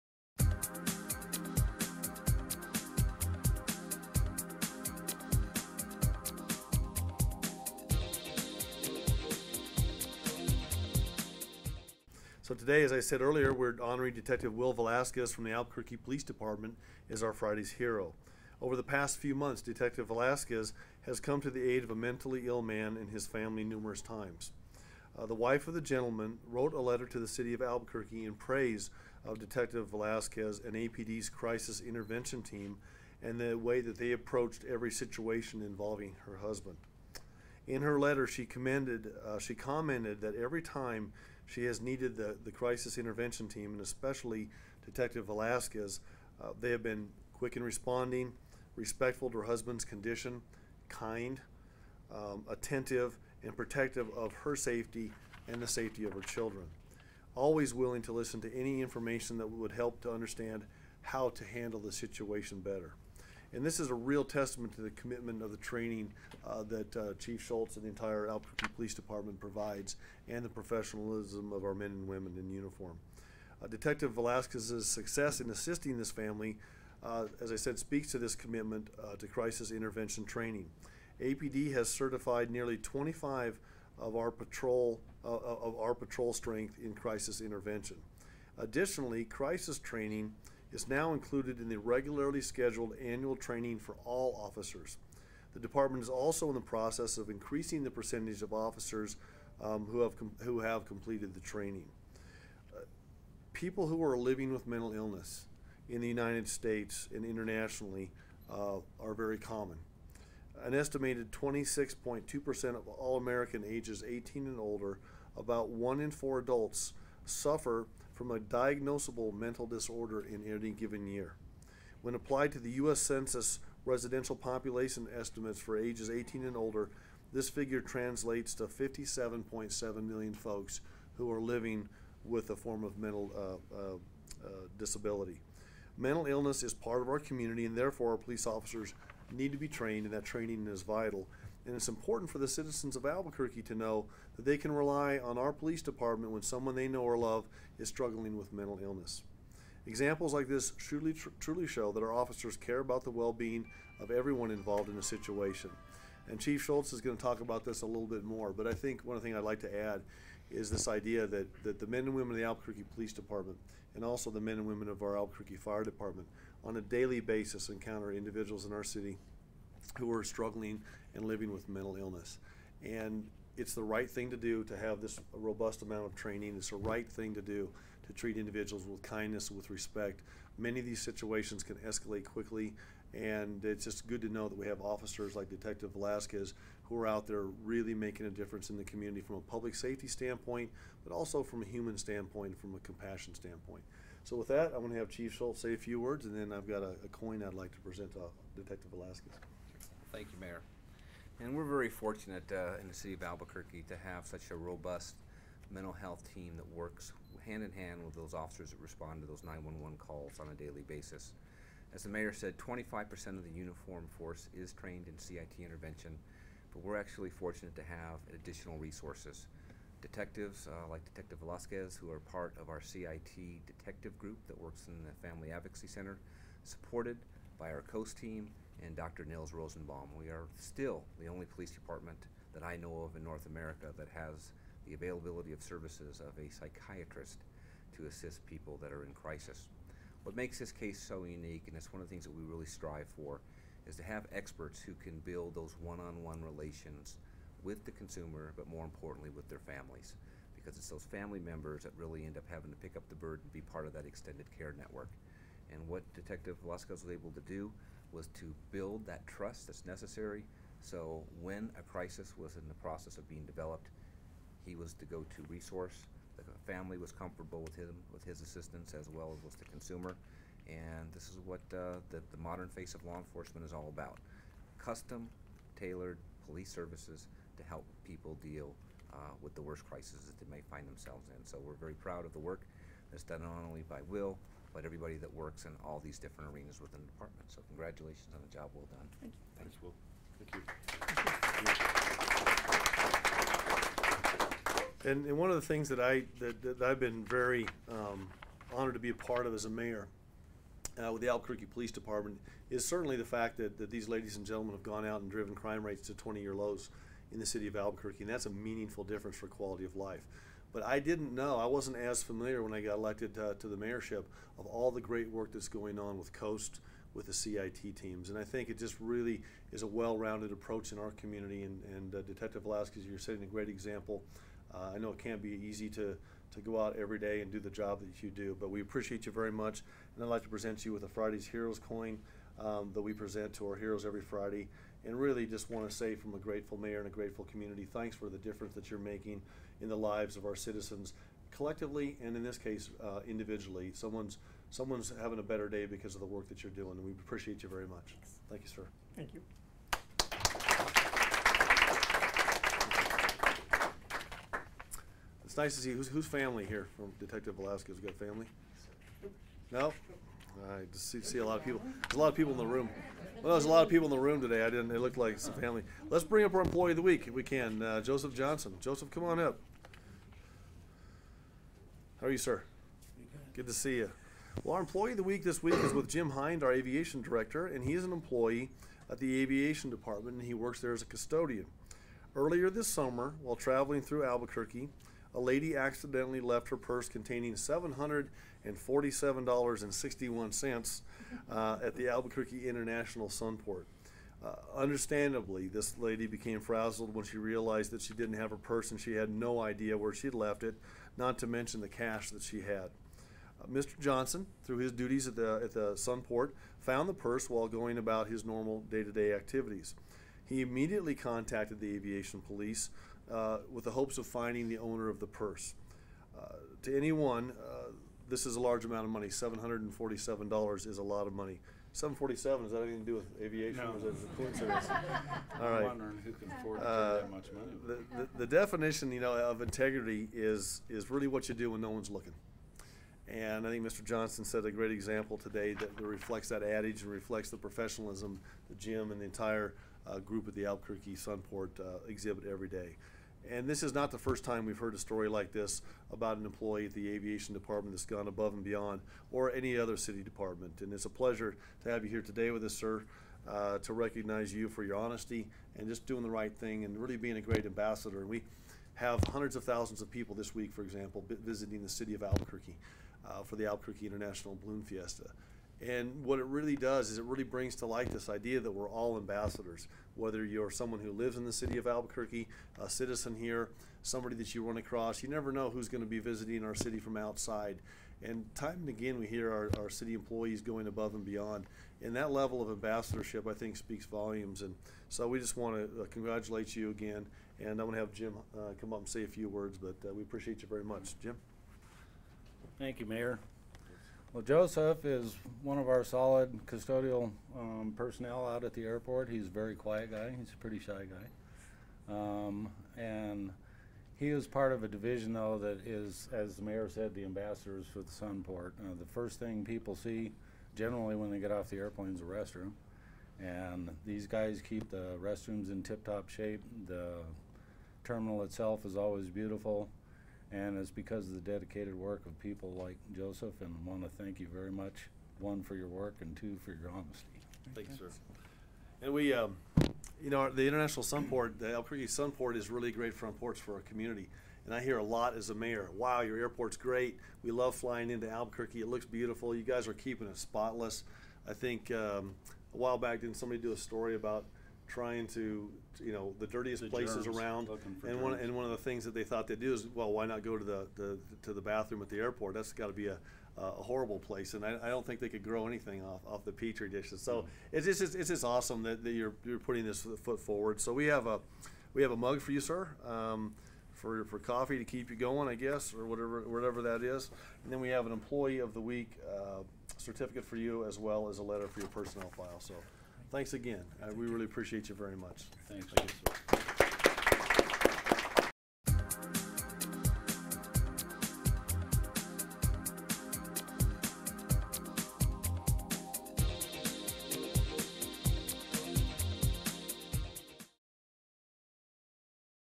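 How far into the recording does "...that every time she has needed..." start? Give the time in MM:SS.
00:40.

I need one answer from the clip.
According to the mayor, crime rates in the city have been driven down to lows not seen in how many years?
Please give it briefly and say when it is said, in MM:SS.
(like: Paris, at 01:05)
20, at 05:06.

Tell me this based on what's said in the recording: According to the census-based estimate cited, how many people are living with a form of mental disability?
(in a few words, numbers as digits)
57.7 million.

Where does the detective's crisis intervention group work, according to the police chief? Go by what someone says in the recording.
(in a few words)
Family Advocacy Center.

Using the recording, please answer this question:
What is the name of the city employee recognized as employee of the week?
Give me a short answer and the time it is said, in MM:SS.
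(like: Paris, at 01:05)
Joseph Johnson, at 06:08.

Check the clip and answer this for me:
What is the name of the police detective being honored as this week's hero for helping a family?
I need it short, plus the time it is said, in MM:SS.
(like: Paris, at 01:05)
Will Velasquez, at 00:14.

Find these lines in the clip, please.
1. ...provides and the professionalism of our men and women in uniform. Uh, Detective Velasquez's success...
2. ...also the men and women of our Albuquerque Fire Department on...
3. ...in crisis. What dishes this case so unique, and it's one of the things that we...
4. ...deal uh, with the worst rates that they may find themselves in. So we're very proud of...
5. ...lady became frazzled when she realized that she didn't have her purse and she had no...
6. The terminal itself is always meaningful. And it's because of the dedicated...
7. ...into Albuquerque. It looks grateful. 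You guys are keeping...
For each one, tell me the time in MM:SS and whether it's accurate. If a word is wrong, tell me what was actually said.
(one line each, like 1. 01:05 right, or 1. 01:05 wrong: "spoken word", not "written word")
1. 01:09 right
2. 02:44 right
3. 03:59 wrong: "makes", not "dishes"
4. 04:38 wrong: "crises", not "rates"
5. 06:35 right
6. 08:36 wrong: "beautiful", not "meaningful"
7. 08:58 wrong: "beautiful", not "grateful".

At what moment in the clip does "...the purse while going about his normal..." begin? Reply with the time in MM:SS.
06:47.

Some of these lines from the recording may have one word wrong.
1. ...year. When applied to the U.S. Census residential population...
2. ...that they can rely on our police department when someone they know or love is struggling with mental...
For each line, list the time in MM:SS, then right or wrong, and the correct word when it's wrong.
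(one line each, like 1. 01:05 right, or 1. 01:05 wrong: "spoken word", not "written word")
1. 02:01 right
2. 02:24 right.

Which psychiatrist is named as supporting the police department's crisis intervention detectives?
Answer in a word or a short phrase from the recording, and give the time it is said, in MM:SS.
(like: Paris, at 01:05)
Nils Rosenbaum, at 03:49.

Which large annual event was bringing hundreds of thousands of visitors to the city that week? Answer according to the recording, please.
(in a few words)
Albuquerque International Balloon Fiesta.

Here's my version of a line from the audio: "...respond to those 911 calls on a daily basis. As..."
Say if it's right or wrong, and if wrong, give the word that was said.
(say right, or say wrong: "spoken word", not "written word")
right.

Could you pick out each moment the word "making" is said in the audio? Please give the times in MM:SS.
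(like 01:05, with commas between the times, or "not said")
03:07, 05:38.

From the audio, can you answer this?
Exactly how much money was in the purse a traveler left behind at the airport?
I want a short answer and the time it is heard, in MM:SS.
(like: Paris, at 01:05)
$747.61, at 06:27.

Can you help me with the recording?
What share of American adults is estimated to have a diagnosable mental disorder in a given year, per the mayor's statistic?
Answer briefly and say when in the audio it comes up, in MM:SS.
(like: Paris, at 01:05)
26.2%, at 01:51.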